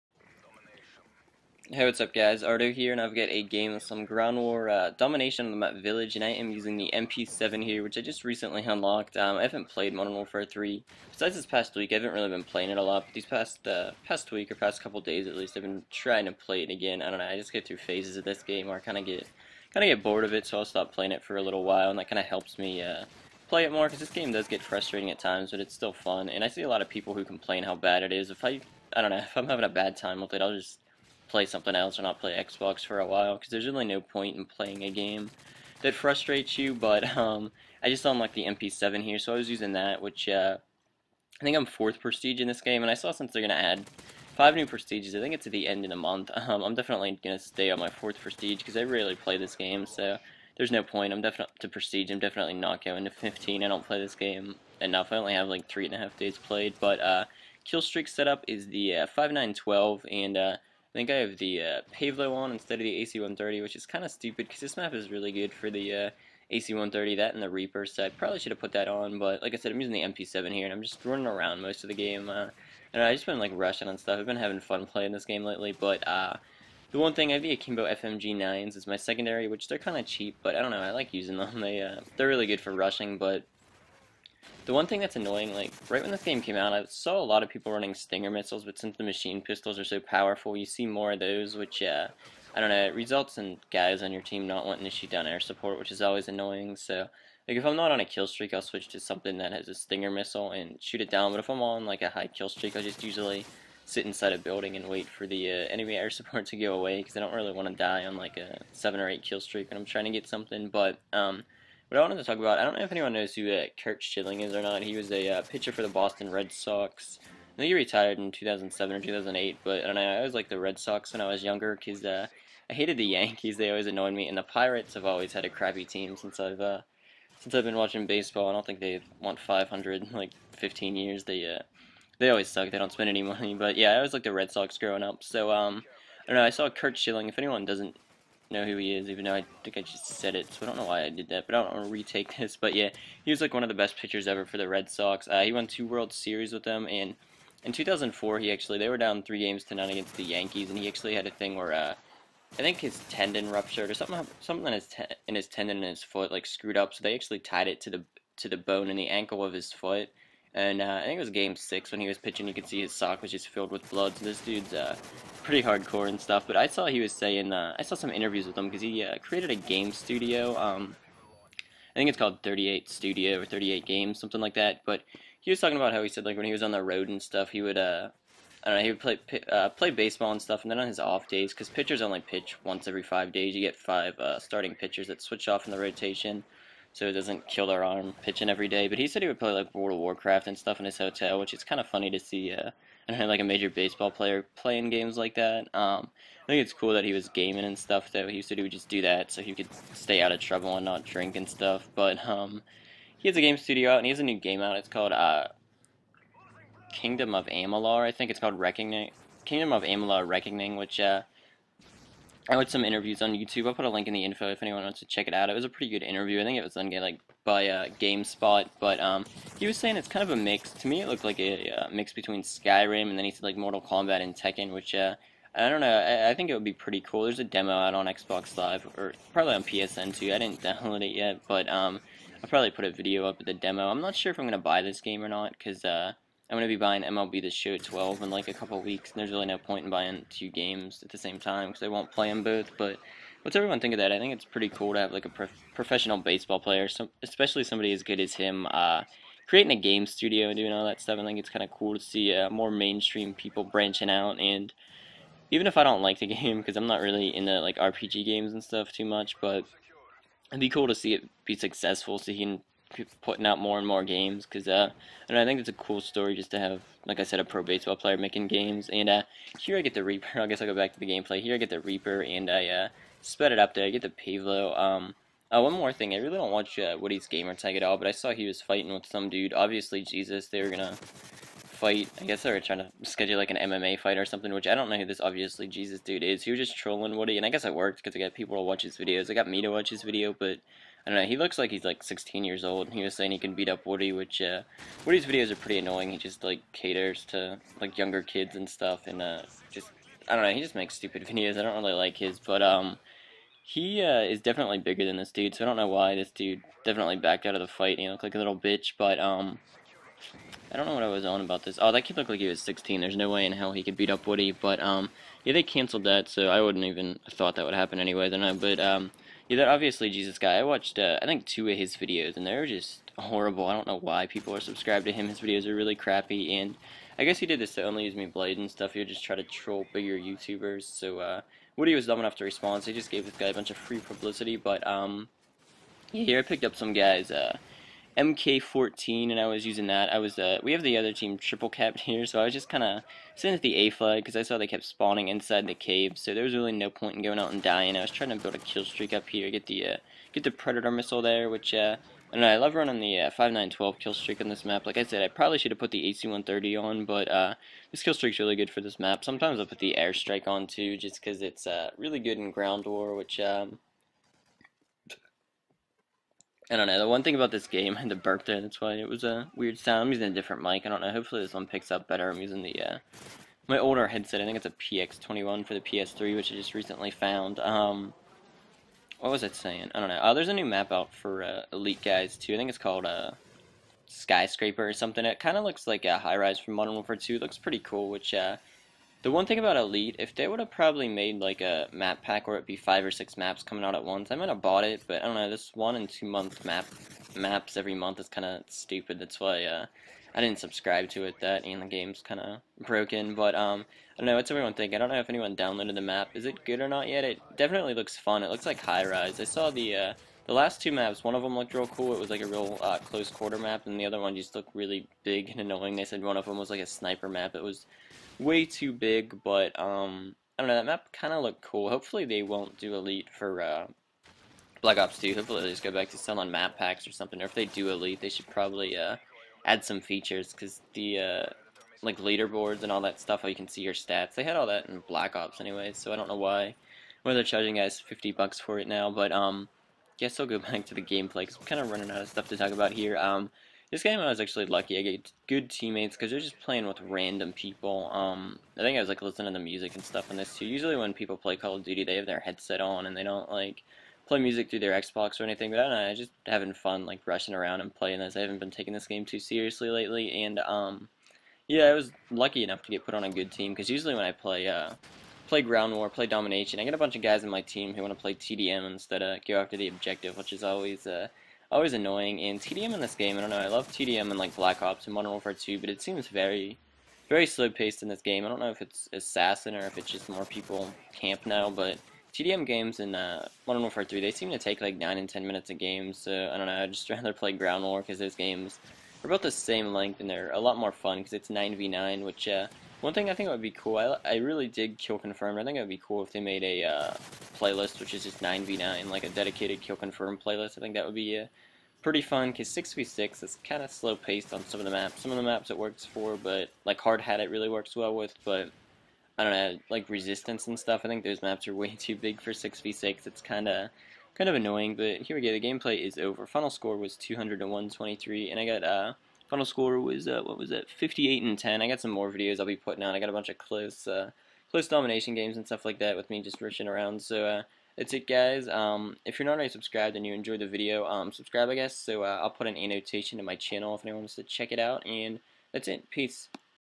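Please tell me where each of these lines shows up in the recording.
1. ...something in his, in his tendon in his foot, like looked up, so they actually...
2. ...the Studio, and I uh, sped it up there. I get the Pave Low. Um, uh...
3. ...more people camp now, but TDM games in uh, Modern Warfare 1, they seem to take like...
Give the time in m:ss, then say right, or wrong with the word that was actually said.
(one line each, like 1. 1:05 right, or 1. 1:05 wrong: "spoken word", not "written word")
1. 2:34 wrong: "screwed", not "looked"
2. 4:31 wrong: "Reaper", not "Studio"
3. 8:00 wrong: "3", not "1".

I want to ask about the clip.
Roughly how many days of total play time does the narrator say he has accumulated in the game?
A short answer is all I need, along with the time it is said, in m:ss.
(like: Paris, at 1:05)
three and a half days, at 0:55.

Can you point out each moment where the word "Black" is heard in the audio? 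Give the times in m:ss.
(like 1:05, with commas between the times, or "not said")
7:04, 7:15, 7:54.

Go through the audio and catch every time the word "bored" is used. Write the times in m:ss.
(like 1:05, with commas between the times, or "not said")
0:20.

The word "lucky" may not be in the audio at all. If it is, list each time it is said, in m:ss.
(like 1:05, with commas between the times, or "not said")
7:24, 7:42.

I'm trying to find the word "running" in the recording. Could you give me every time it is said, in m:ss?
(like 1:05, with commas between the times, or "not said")
1:11, 1:27, 5:52, 7:21.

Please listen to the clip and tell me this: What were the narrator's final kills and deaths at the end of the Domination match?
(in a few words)
58 and 10.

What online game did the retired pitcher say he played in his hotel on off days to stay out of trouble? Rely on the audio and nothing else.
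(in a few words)
World of Warcraft.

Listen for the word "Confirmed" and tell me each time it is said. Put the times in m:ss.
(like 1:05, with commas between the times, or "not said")
8:15, 8:19.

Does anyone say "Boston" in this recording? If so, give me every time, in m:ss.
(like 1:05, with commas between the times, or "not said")
1:55.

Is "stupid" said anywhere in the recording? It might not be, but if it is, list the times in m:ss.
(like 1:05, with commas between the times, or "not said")
1:04, 5:00, 6:38.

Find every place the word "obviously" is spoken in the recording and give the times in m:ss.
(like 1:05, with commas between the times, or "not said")
4:39, 4:45, 5:19.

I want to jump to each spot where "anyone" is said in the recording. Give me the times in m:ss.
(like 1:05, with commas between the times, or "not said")
1:52, 2:17, 3:34, 6:45, 8:54.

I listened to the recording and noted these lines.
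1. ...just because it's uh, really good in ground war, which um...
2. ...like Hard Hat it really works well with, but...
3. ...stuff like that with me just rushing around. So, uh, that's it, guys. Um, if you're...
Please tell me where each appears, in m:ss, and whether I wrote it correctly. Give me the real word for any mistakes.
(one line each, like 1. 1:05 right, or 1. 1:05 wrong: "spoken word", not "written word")
1. 6:00 right
2. 8:26 right
3. 8:45 right.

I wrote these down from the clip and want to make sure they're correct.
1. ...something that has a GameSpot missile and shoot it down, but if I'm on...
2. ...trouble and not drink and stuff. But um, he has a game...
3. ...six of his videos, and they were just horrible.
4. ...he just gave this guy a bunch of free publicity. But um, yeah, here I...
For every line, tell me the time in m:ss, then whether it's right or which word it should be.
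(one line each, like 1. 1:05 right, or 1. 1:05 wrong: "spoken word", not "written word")
1. 1:38 wrong: "Stinger", not "GameSpot"
2. 3:20 right
3. 5:21 wrong: "two", not "six"
4. 5:32 right.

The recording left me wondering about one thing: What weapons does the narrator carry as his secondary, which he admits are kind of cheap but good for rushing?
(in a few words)
Akimbo FMG9s.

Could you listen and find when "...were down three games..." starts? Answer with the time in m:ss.
2:28.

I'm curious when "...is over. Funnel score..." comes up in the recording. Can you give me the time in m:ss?
8:36.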